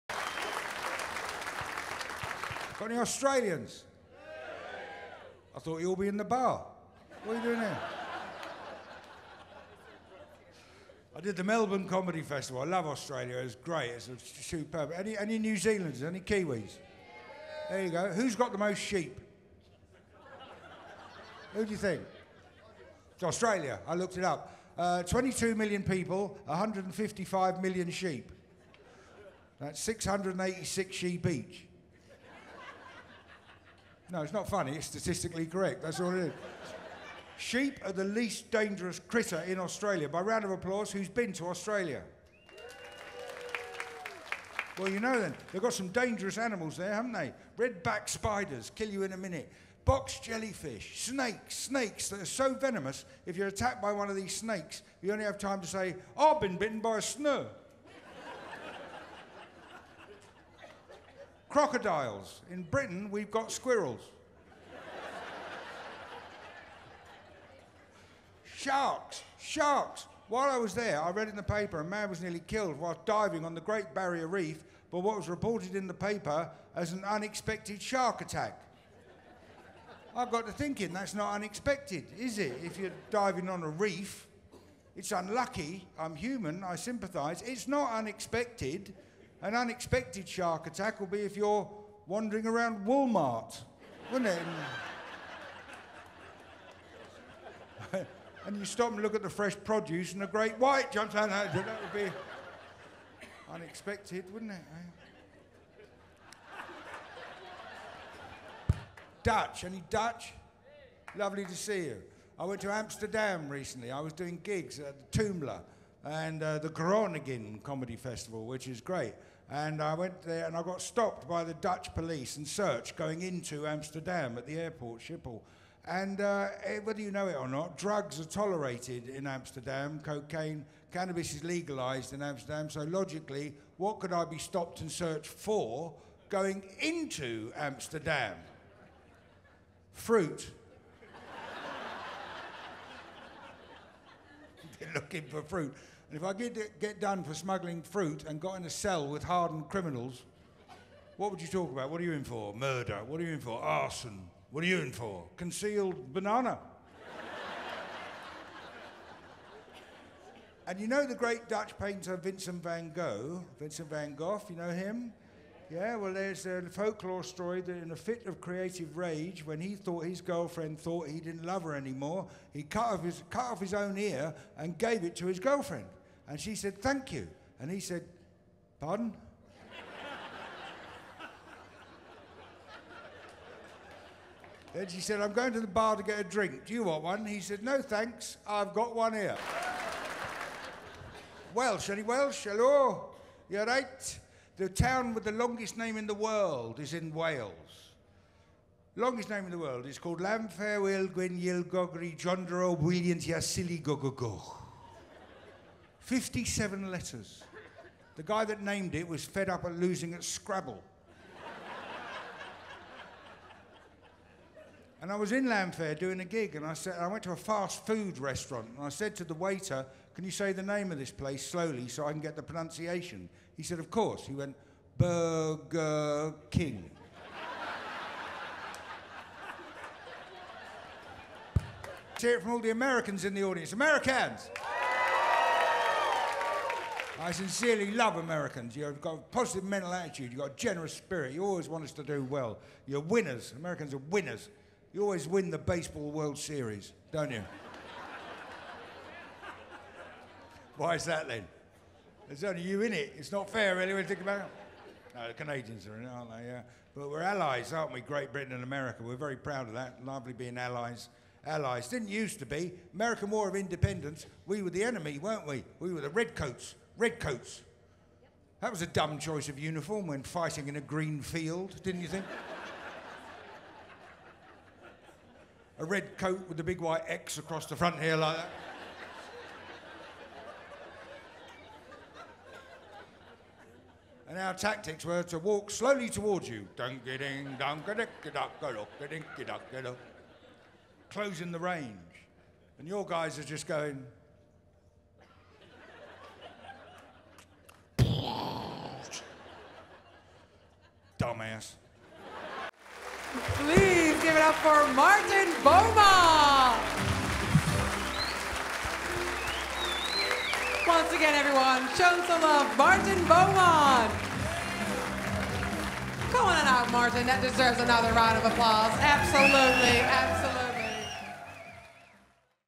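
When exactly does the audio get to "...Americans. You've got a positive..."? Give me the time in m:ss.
3:58.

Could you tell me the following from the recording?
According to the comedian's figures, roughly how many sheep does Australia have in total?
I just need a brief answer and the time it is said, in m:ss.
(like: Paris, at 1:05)
155 million, at 0:26.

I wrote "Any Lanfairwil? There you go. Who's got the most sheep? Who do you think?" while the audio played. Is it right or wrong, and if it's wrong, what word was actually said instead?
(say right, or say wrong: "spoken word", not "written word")
wrong: "Kiwis", not "Lanfairwil".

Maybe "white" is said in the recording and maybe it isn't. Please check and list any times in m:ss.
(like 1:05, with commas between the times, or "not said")
1:40, 4:36.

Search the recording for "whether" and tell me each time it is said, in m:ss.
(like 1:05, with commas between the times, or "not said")
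2:06.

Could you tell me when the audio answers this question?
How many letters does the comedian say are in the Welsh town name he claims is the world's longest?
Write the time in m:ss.
3:26.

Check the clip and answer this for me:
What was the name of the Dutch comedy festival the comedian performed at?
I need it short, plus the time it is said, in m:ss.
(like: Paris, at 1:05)
Groningen Comedy Festival, at 1:56.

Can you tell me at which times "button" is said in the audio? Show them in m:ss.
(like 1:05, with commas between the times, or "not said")
not said.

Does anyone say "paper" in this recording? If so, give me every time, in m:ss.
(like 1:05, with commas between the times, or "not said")
1:11, 1:15.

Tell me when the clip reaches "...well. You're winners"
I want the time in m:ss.
4:02.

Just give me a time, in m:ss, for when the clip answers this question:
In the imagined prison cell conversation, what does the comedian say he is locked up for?
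2:35.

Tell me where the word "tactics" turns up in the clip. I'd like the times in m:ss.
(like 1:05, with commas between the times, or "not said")
4:44.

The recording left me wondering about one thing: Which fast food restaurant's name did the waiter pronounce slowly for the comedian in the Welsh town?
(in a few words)
Burger King.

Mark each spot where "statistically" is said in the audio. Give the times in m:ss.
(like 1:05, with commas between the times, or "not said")
0:34.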